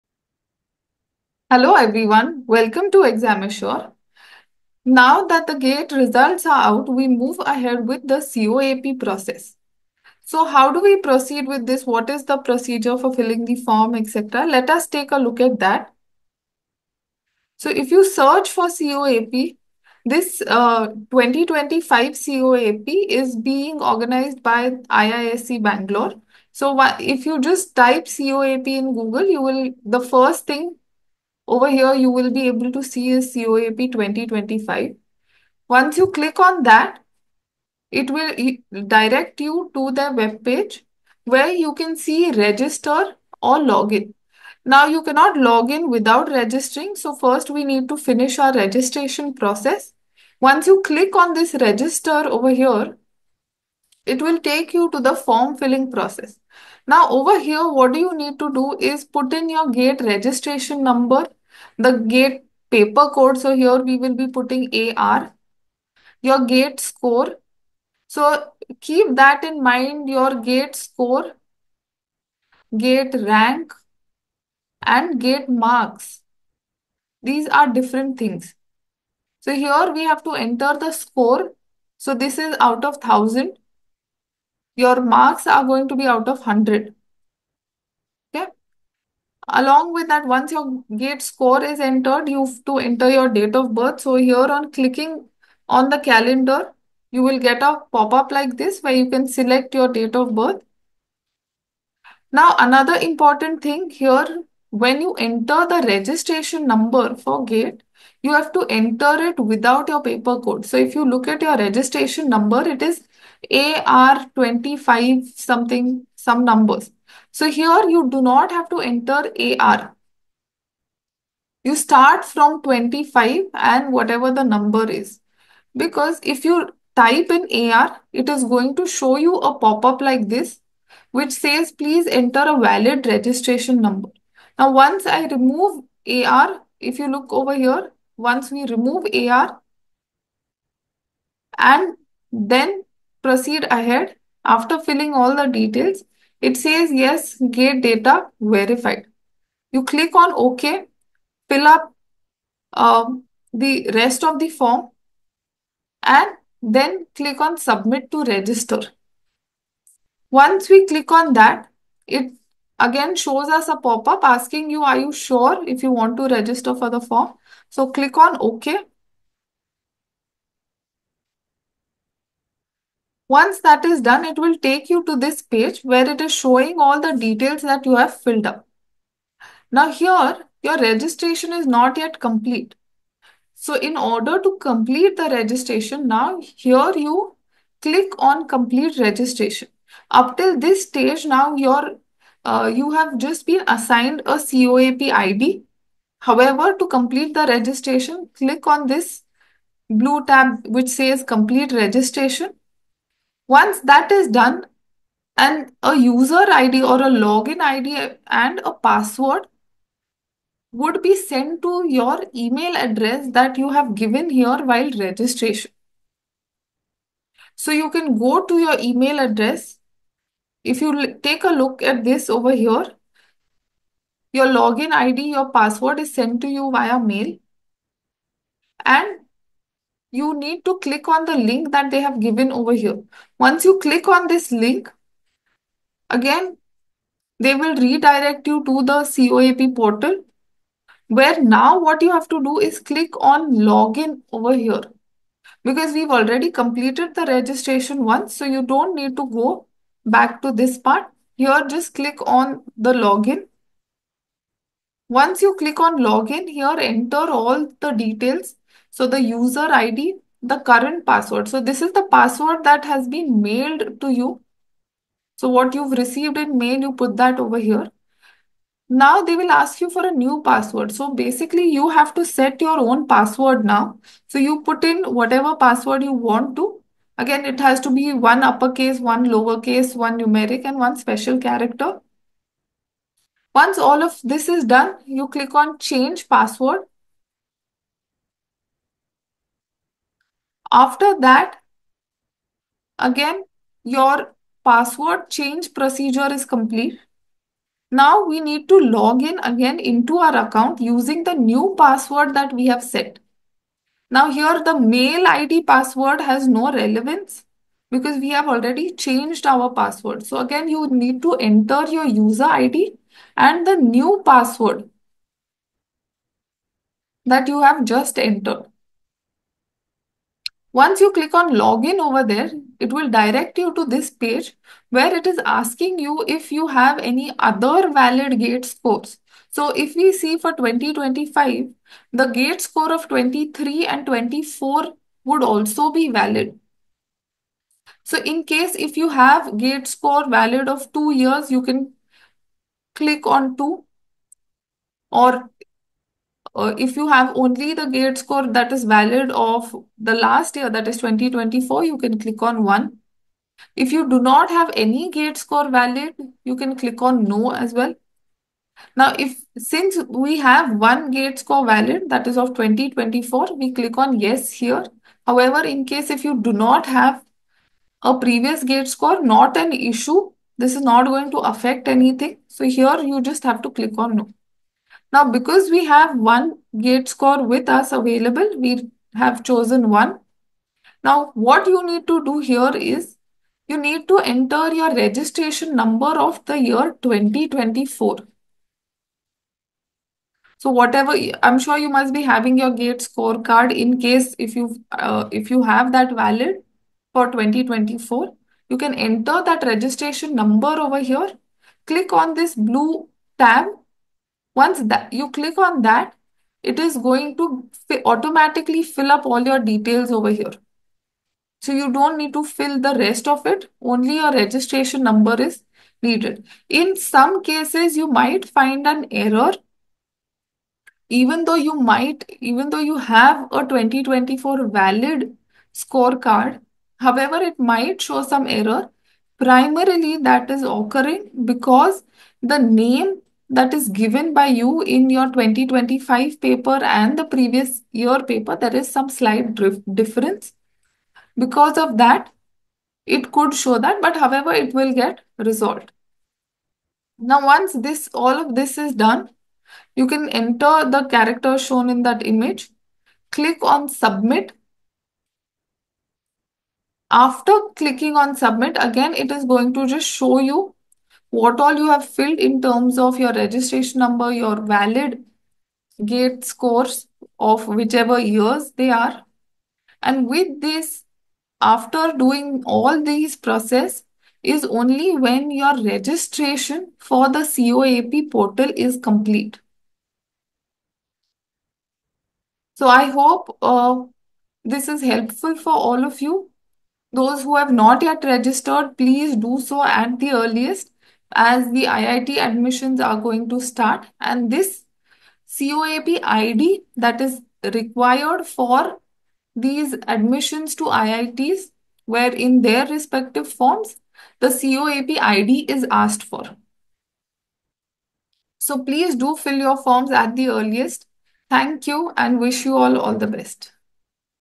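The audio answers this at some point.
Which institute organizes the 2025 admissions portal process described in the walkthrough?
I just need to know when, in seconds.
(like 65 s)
24 s.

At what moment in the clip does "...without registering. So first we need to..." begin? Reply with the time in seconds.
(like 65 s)
45 s.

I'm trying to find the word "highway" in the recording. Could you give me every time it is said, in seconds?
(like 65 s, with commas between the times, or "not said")
not said.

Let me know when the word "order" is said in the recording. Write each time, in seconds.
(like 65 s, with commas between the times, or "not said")
183 s.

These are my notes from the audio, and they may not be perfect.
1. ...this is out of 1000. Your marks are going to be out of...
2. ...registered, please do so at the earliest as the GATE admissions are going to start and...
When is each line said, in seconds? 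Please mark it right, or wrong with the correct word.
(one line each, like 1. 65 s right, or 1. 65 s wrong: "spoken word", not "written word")
1. 82 s right
2. 488 s wrong: "IIT", not "GATE".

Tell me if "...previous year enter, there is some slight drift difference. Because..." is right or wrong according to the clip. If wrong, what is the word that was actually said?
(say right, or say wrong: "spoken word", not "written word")
wrong: "paper", not "enter".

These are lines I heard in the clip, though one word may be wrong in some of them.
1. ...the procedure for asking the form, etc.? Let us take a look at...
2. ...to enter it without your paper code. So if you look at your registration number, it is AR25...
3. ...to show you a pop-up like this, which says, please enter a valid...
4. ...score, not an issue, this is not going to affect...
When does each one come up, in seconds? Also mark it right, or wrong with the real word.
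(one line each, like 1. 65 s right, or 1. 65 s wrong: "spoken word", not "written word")
1. 12 s wrong: "filling", not "asking"
2. 108 s right
3. 128 s right
4. 368 s right.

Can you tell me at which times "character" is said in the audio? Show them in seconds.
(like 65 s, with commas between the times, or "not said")
281 s, 451 s.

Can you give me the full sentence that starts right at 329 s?
So if we see for 2025, the GATE score of 23 and 24 would also be valid.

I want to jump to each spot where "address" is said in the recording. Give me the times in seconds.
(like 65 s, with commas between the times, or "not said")
212 s, 219 s.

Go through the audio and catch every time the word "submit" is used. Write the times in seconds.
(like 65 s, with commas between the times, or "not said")
157 s, 453 s, 458 s.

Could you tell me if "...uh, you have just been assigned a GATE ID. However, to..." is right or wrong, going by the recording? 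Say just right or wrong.
wrong.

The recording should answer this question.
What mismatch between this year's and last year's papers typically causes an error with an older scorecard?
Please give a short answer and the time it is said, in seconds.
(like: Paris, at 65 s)
The name, at 432 s.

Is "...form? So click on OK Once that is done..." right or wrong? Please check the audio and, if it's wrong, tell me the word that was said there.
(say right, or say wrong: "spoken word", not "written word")
right.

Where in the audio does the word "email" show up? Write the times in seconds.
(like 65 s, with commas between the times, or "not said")
212 s, 218 s.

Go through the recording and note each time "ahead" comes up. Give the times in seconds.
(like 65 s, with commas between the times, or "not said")
7 s, 143 s.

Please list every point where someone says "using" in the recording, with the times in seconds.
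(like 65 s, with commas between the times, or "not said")
300 s.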